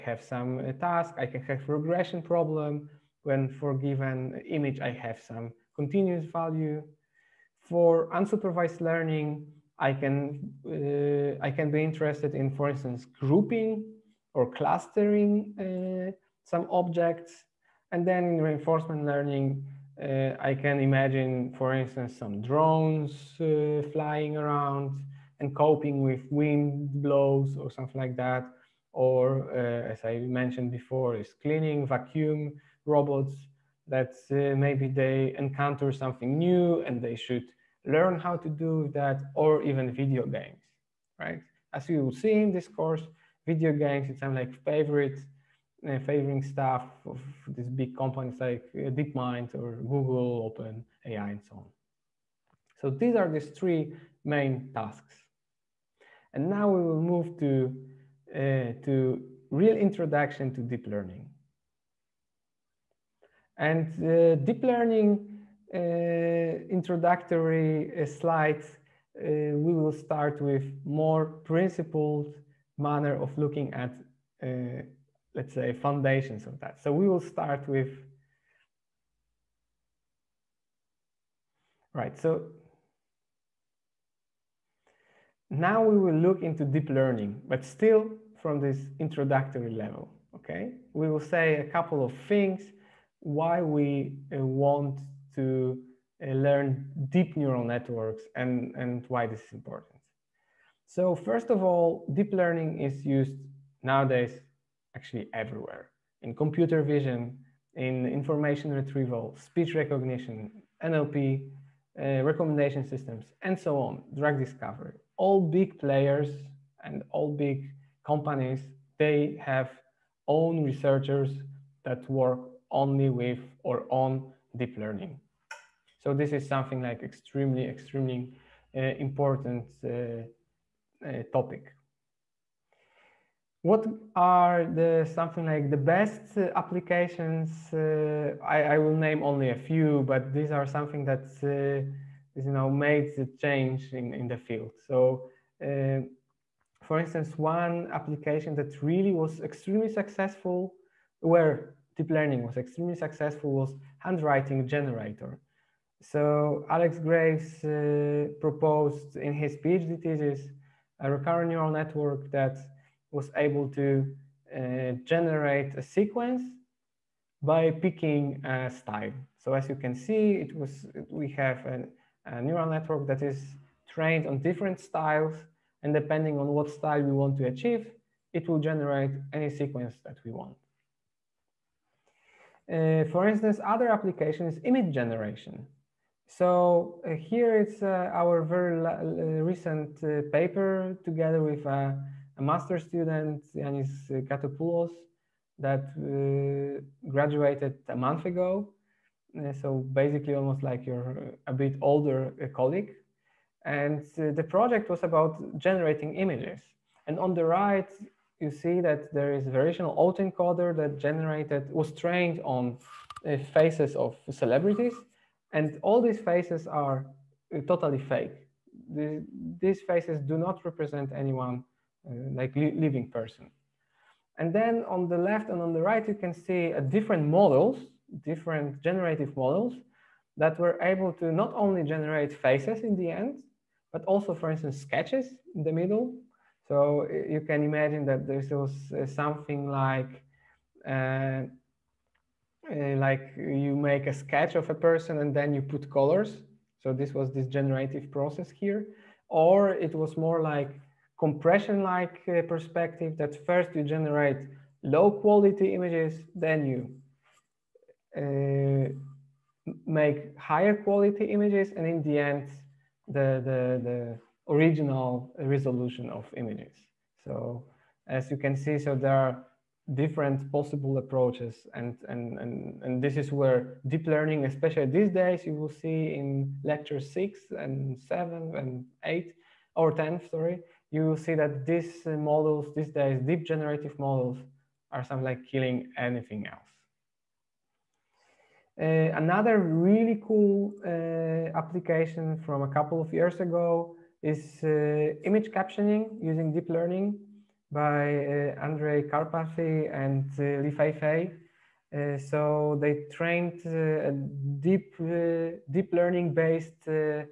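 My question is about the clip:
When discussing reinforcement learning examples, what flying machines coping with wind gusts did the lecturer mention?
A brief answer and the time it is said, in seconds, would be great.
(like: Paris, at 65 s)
drones, at 22 s.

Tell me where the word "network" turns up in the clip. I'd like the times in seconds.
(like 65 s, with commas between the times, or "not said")
97 s, 161 s, 172 s.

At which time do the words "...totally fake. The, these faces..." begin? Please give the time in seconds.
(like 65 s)
217 s.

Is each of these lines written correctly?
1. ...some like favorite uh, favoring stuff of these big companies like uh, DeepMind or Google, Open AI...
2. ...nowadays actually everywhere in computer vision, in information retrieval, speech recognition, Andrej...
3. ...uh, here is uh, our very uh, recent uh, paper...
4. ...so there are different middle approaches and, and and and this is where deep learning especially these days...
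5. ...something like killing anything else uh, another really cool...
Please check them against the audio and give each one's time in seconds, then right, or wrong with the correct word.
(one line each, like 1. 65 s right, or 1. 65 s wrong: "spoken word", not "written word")
1. 44 s right
2. 103 s wrong: "NLP", not "Andrej"
3. 187 s right
4. 268 s wrong: "possible", not "middle"
5. 285 s right.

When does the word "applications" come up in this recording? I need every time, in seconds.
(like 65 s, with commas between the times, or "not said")
136 s, 147 s, 183 s, 291 s.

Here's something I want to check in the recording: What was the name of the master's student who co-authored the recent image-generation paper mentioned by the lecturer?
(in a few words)
Yanis Gatopoulos.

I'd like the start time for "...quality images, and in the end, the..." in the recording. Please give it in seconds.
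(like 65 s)
260 s.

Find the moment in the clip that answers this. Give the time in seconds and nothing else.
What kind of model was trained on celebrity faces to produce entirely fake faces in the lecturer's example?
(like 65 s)
209 s.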